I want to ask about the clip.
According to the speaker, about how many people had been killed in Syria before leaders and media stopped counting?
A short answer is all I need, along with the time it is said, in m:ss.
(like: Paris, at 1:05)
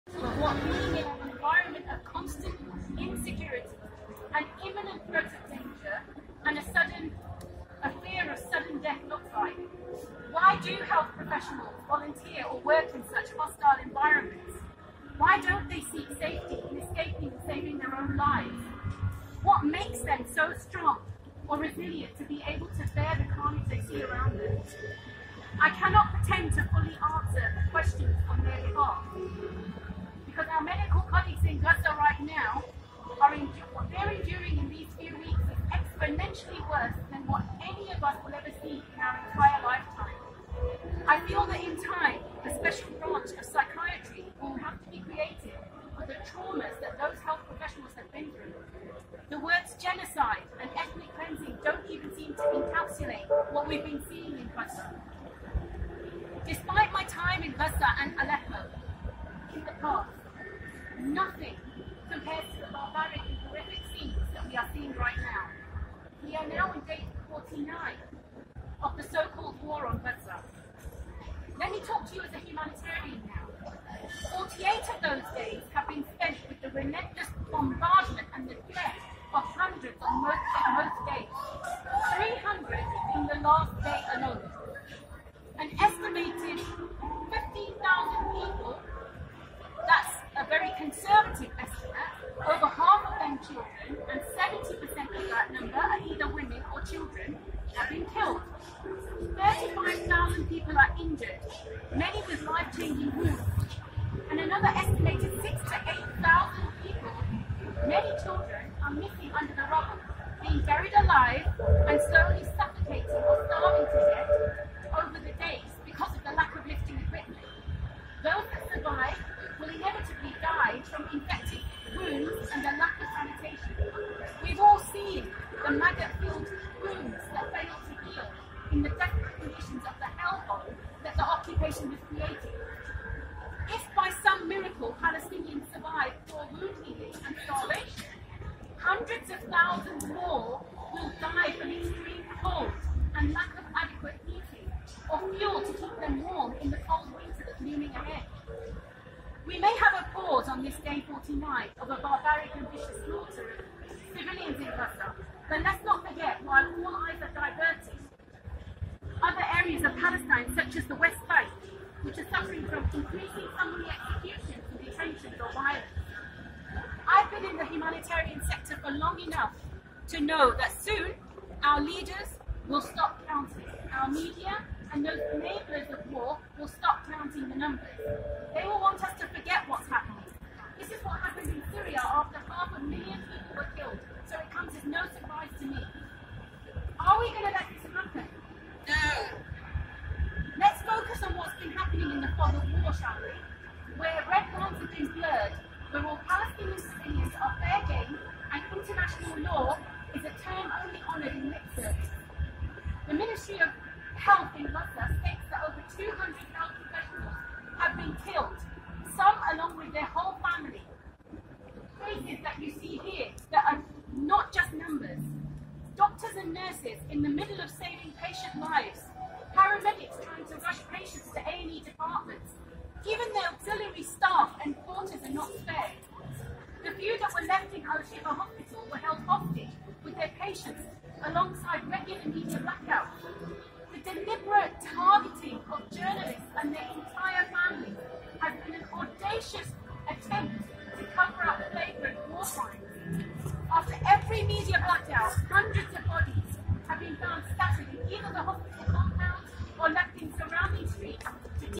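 half a million, at 3:02.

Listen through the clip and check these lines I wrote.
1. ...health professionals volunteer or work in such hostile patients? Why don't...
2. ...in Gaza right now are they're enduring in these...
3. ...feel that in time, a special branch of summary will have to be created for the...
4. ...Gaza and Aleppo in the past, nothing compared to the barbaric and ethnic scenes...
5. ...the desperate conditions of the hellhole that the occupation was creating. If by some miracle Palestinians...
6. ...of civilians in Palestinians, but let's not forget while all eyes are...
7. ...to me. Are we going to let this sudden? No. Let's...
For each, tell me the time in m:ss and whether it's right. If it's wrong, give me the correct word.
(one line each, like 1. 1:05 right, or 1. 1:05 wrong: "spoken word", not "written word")
1. 0:10 wrong: "environments", not "patients"
2. 0:31 right
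3. 0:41 wrong: "psychiatry", not "summary"
4. 0:57 wrong: "horrific", not "ethnic"
5. 2:08 right
6. 2:33 wrong: "Gaza", not "Palestinians"
7. 3:05 wrong: "happen", not "sudden".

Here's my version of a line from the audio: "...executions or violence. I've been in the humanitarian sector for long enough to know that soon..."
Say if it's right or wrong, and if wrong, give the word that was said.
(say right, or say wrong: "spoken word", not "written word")
wrong: "detentions", not "executions".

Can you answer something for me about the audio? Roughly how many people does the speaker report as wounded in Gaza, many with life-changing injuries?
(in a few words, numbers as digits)
35,000.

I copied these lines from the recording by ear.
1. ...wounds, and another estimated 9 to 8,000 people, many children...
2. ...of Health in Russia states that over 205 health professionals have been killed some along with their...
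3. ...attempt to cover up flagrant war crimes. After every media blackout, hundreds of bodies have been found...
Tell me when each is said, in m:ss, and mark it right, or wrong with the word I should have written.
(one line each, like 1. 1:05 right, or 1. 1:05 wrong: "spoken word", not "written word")
1. 1:43 wrong: "6", not "9"
2. 3:23 wrong: "200", not "205"
3. 4:00 right.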